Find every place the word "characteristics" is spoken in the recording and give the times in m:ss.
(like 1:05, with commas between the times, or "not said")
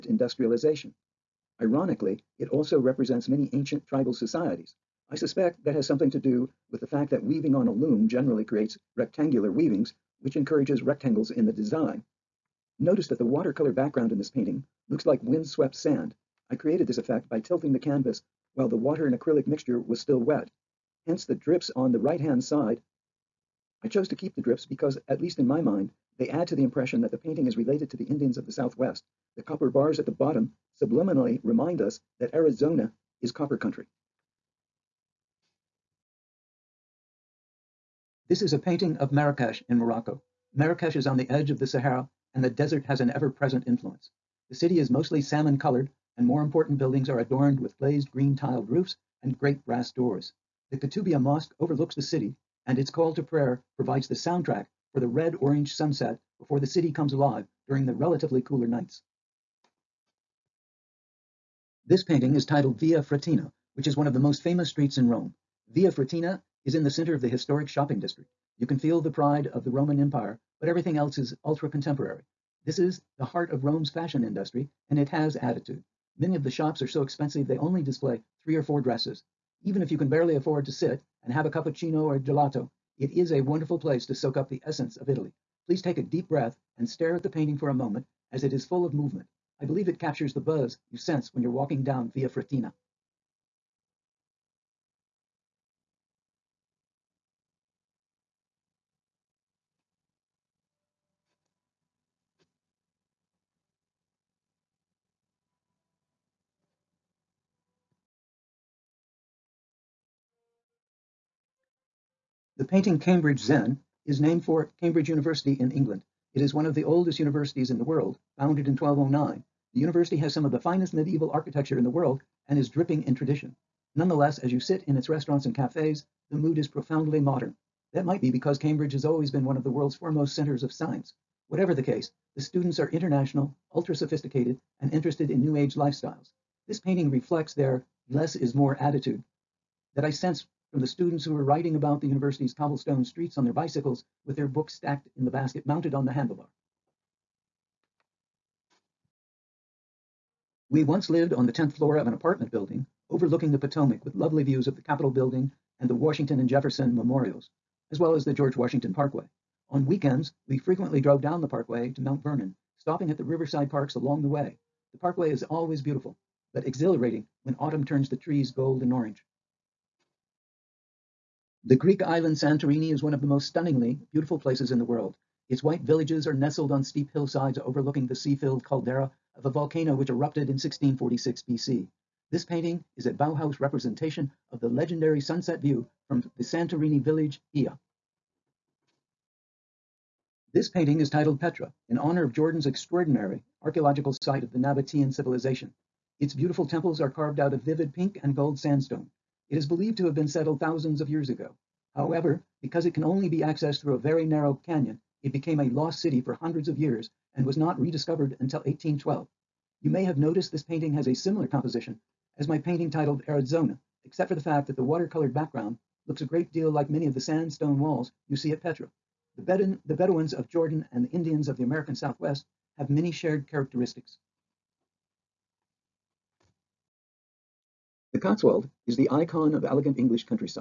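3:43.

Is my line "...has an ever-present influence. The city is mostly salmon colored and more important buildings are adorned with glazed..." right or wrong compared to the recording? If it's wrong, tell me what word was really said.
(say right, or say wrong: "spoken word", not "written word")
right.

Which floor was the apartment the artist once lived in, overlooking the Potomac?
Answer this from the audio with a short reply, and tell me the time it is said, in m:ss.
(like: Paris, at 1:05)
10th, at 2:31.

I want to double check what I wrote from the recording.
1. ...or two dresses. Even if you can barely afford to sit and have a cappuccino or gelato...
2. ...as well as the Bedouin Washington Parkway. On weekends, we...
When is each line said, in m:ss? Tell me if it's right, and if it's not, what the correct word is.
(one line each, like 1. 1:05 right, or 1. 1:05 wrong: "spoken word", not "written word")
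1. 1:18 wrong: "four", not "two"
2. 2:37 wrong: "George", not "Bedouin".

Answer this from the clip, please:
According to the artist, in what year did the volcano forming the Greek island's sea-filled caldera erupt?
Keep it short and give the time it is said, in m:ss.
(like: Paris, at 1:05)
1646 BC, at 3:00.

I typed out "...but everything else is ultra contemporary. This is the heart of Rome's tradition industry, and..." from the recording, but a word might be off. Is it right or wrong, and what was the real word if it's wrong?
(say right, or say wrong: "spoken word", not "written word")
wrong: "fashion", not "tradition".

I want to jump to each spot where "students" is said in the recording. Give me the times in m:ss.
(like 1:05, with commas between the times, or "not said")
2:12, 2:20.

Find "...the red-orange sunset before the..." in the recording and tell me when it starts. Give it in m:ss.
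0:54.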